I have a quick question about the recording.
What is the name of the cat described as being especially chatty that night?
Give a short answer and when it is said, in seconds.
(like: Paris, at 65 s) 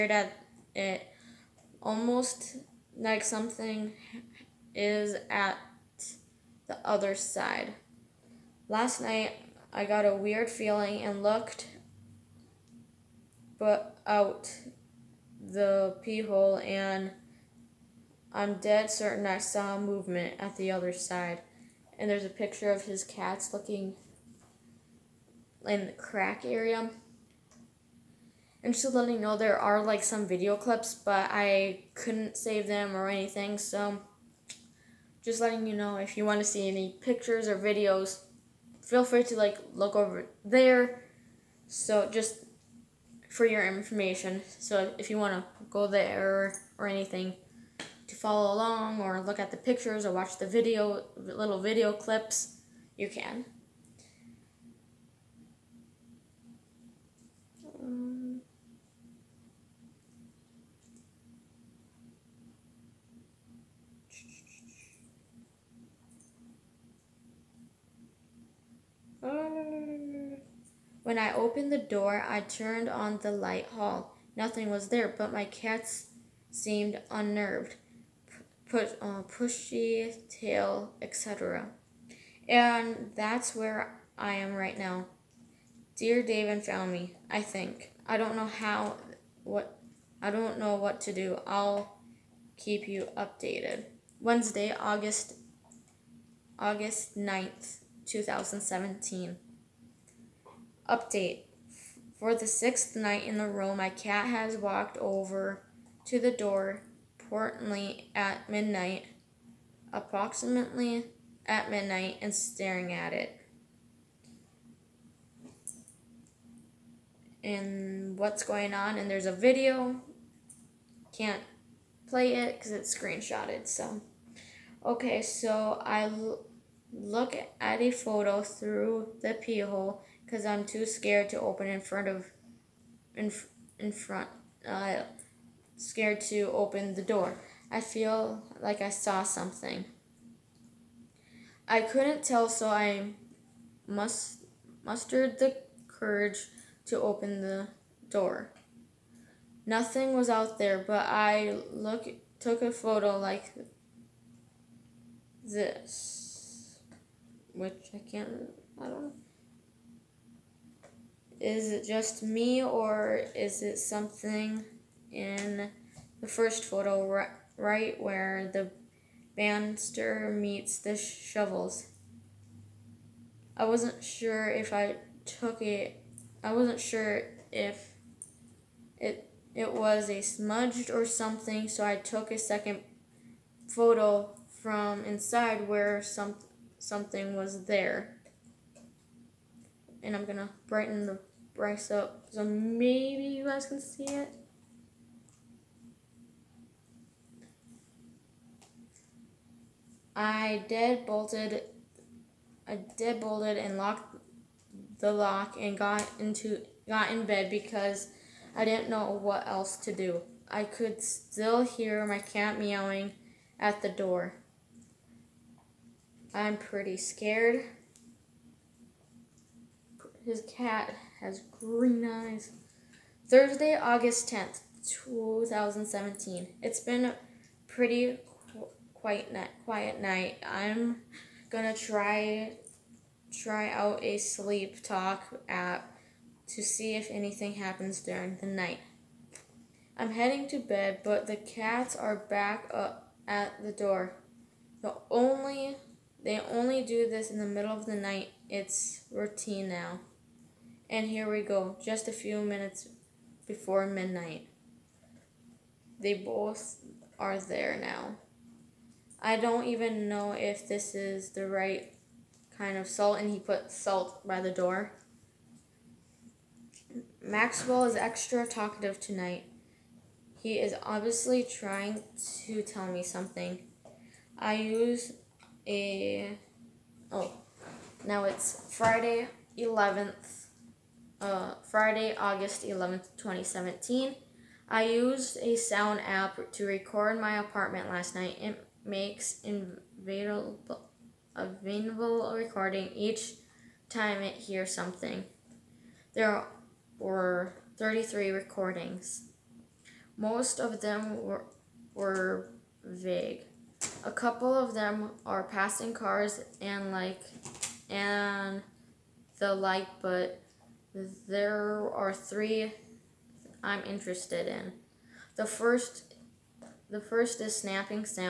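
Maxwell, at 267 s.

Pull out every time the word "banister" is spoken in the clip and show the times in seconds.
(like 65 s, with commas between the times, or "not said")
169 s.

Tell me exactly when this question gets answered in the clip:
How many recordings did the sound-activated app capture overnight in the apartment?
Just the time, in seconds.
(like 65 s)
297 s.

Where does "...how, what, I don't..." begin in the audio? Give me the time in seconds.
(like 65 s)
88 s.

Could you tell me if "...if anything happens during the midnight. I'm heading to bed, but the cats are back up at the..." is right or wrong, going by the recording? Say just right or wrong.
wrong.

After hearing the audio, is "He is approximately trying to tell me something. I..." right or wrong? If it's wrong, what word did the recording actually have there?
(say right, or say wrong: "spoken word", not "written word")
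wrong: "obviously", not "approximately".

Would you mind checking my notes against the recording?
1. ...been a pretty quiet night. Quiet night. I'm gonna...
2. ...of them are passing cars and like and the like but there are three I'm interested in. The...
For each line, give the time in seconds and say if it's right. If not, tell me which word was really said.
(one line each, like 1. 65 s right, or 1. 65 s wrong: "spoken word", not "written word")
1. 226 s right
2. 304 s right.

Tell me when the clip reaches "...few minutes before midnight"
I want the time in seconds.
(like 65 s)
252 s.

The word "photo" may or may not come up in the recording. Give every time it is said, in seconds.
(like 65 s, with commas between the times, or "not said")
127 s, 152 s, 166 s, 183 s.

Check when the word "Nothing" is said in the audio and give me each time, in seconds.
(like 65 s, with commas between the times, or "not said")
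74 s, 149 s.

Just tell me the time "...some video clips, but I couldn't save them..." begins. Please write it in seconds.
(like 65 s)
30 s.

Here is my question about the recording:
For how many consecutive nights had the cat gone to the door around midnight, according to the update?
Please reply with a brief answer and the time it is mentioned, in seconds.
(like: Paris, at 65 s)
6, at 102 s.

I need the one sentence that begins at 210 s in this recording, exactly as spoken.
I could still hear my cat meowing at the door.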